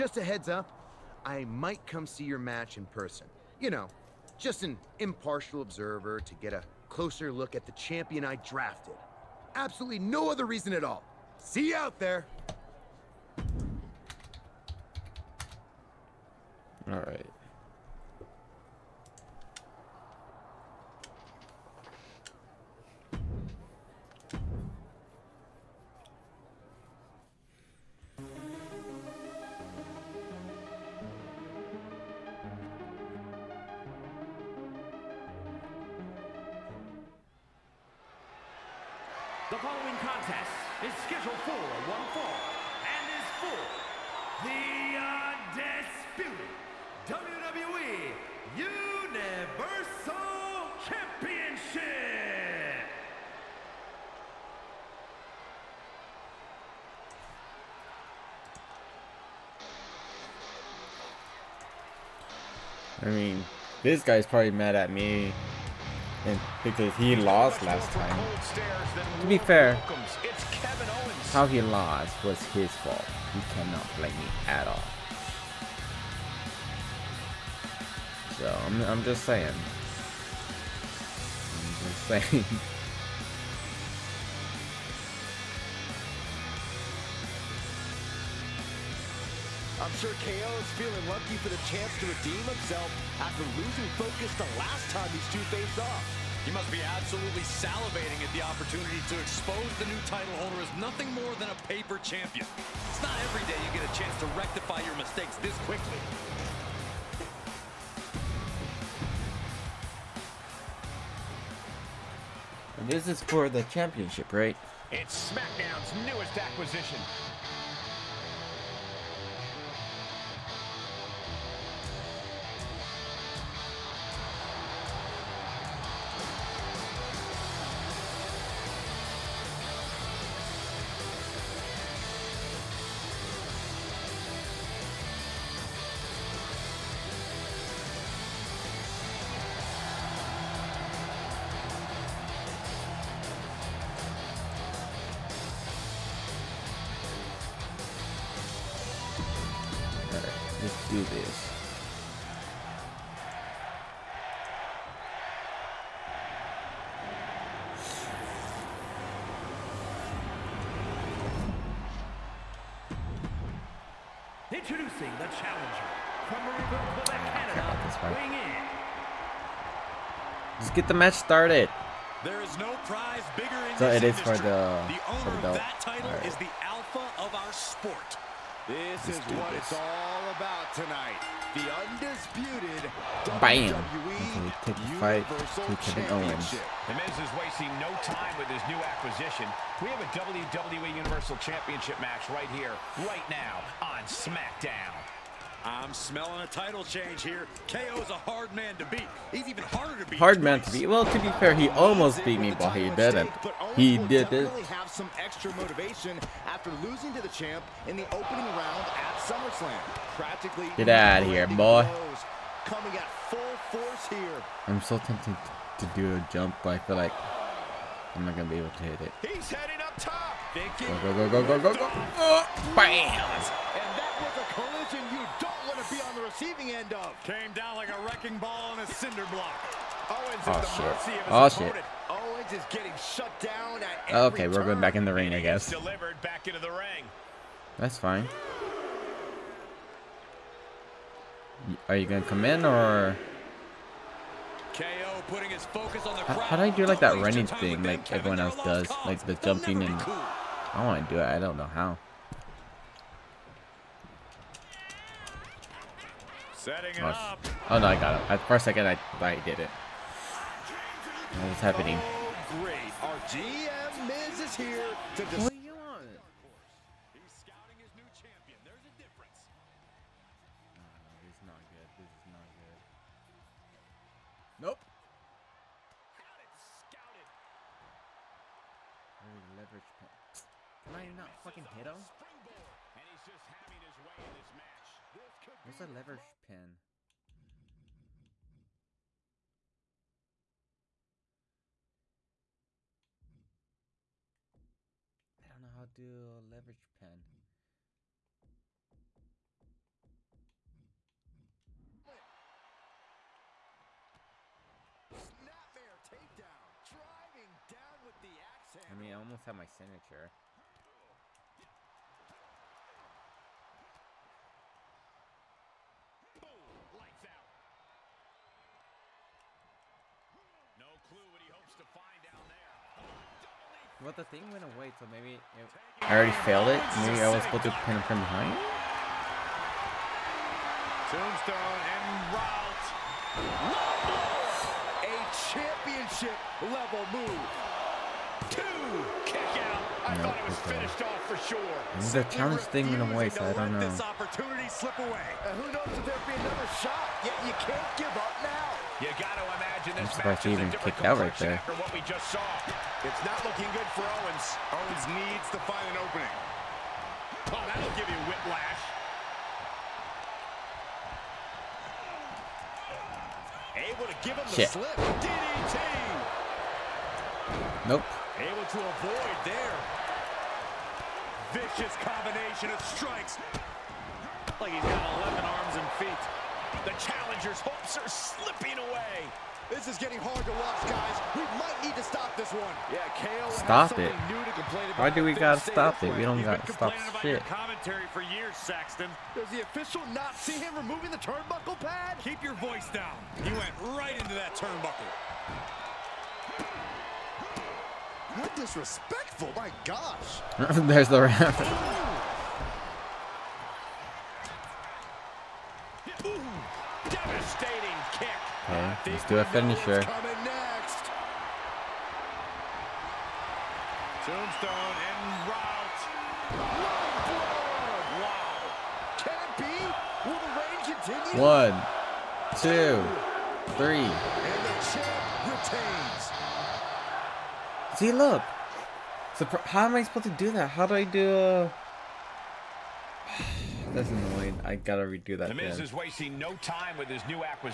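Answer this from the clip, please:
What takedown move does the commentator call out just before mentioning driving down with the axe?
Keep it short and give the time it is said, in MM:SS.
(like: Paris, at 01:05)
Snapmare, at 05:05.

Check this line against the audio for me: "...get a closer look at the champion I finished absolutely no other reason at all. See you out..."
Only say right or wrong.
wrong.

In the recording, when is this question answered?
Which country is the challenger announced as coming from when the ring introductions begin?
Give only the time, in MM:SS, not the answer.
02:47.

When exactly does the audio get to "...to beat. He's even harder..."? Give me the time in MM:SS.
03:18.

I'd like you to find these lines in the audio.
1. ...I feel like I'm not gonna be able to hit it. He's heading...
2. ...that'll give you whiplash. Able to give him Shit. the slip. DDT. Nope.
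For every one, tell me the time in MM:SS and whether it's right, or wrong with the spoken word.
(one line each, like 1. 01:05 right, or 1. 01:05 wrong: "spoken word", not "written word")
1. 03:36 right
2. 05:57 right.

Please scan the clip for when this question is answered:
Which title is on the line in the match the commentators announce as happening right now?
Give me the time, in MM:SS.
03:10.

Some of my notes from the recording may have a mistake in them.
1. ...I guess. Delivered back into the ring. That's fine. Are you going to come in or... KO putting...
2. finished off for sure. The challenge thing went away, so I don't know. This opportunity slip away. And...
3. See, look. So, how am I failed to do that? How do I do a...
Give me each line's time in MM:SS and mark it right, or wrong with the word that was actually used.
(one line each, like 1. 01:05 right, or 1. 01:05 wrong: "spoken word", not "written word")
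1. 03:55 right
2. 05:40 right
3. 07:07 wrong: "supposed", not "failed".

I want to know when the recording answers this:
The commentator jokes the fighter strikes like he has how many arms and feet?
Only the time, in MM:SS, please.
06:15.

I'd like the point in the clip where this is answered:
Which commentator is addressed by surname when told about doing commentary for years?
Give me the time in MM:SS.
06:28.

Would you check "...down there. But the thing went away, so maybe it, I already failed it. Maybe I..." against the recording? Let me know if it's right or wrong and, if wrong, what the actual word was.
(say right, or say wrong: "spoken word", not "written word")
right.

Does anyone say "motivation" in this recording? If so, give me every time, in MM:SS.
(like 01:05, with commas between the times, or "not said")
03:25.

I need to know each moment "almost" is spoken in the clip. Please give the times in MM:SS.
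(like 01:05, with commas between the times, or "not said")
03:21, 05:09.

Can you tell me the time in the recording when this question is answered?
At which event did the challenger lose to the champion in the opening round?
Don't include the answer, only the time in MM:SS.
03:29.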